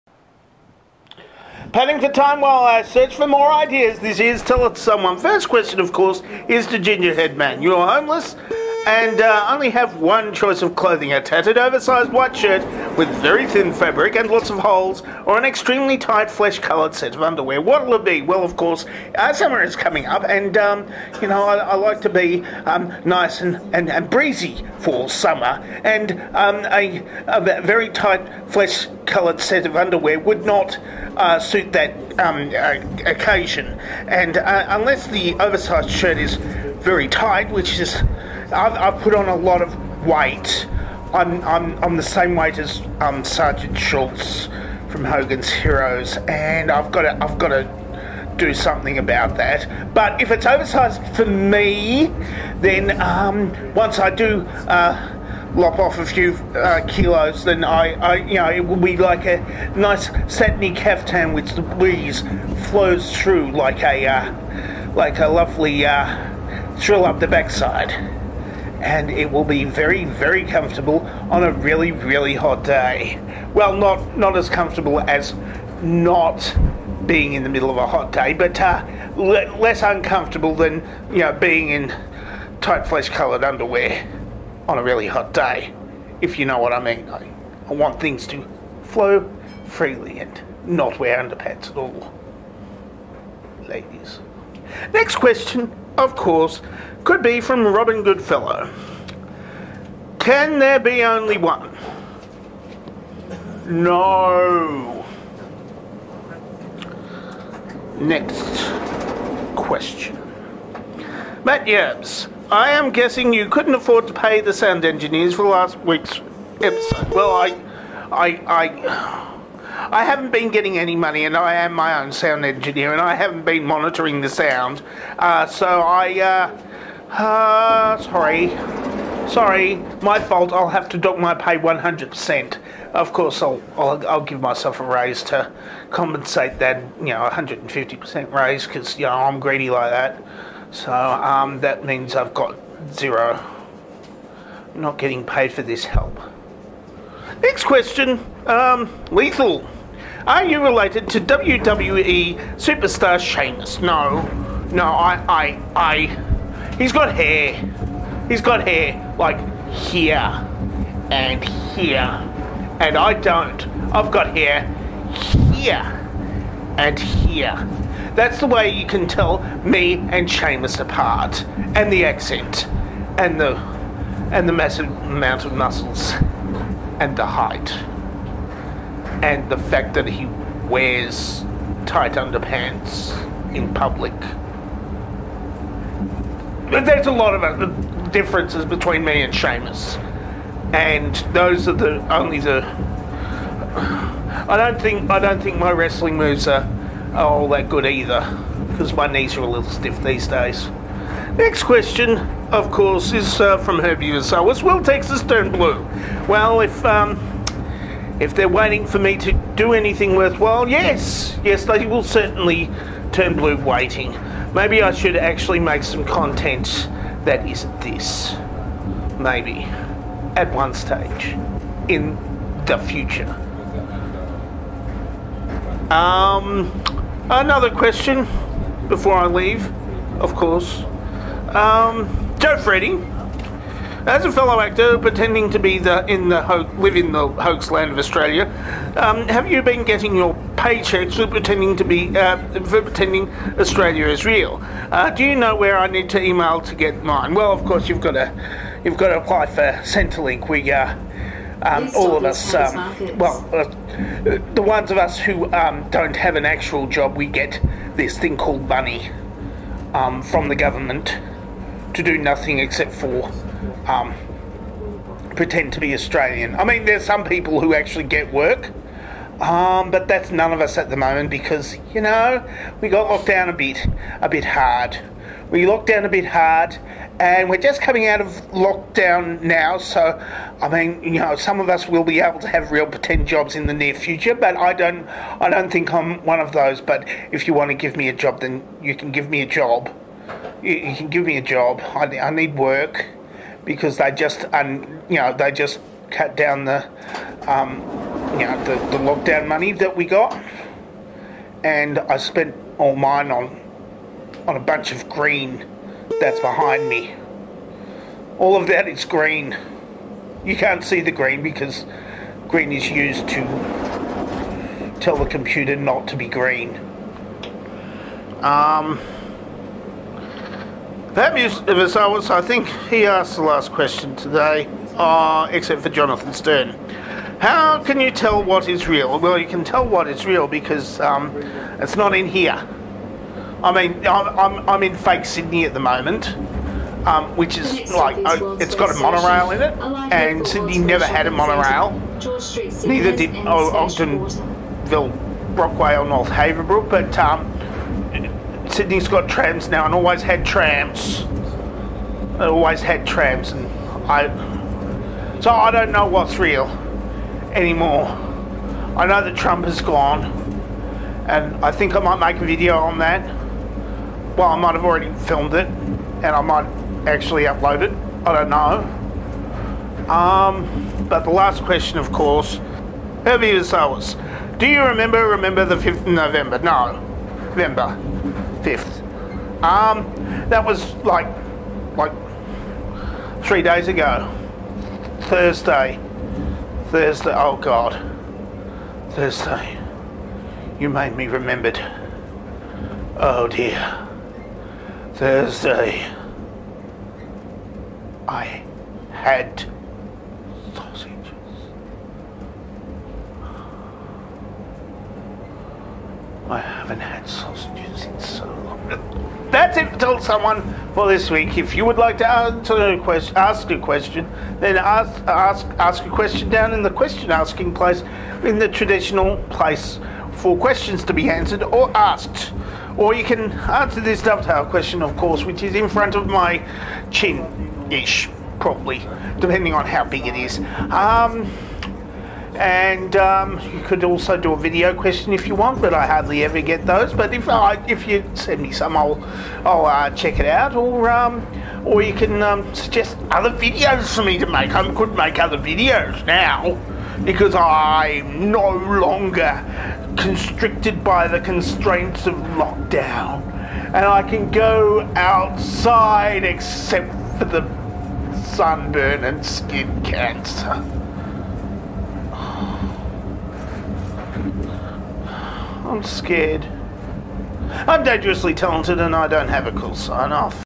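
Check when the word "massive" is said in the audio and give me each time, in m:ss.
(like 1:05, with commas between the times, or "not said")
2:54.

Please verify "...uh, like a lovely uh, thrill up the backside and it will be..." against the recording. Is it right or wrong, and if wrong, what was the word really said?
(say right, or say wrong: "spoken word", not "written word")
right.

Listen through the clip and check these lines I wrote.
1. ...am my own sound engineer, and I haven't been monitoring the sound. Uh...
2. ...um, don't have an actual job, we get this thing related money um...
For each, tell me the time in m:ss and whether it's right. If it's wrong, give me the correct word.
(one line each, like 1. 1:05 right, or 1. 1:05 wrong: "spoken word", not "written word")
1. 2:01 right
2. 4:15 wrong: "called", not "related".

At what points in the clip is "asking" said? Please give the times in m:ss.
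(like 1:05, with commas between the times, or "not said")
6:57.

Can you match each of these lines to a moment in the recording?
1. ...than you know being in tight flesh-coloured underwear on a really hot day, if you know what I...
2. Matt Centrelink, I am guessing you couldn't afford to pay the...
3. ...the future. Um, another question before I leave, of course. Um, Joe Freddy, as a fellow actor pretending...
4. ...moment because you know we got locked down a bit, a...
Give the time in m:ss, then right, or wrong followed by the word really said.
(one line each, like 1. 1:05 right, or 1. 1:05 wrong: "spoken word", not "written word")
1. 1:20 right
2. 1:51 wrong: "Yabs", not "Centrelink"
3. 3:42 right
4. 4:30 right.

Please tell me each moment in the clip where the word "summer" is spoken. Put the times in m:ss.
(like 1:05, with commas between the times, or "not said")
0:19, 0:25.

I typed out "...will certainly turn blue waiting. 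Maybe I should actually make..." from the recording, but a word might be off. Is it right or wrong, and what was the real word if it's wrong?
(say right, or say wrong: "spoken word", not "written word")
right.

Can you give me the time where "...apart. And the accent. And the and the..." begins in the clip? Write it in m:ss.
2:50.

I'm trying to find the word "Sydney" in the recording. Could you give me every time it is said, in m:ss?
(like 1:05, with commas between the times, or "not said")
5:35, 5:40, 5:48.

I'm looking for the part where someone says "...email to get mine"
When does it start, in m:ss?
4:06.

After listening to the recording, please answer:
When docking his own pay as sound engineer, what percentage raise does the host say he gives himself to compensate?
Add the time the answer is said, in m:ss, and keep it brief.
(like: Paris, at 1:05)
150%, at 2:17.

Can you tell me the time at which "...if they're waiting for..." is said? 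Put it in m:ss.
3:28.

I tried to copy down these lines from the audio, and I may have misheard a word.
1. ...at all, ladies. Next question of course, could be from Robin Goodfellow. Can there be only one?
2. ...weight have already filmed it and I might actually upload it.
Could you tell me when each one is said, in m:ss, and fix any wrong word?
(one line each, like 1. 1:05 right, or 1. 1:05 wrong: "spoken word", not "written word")
1. 1:31 right
2. 6:04 wrong: "might", not "weight".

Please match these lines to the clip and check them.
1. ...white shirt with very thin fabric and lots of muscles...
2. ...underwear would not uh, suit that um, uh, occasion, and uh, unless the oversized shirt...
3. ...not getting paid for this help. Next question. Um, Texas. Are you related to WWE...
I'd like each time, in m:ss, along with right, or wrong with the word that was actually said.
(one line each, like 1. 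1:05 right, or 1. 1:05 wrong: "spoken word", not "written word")
1. 0:12 wrong: "holes", not "muscles"
2. 0:29 right
3. 2:24 wrong: "Lethal", not "Texas".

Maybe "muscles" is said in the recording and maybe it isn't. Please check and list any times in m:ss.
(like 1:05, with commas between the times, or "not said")
2:55.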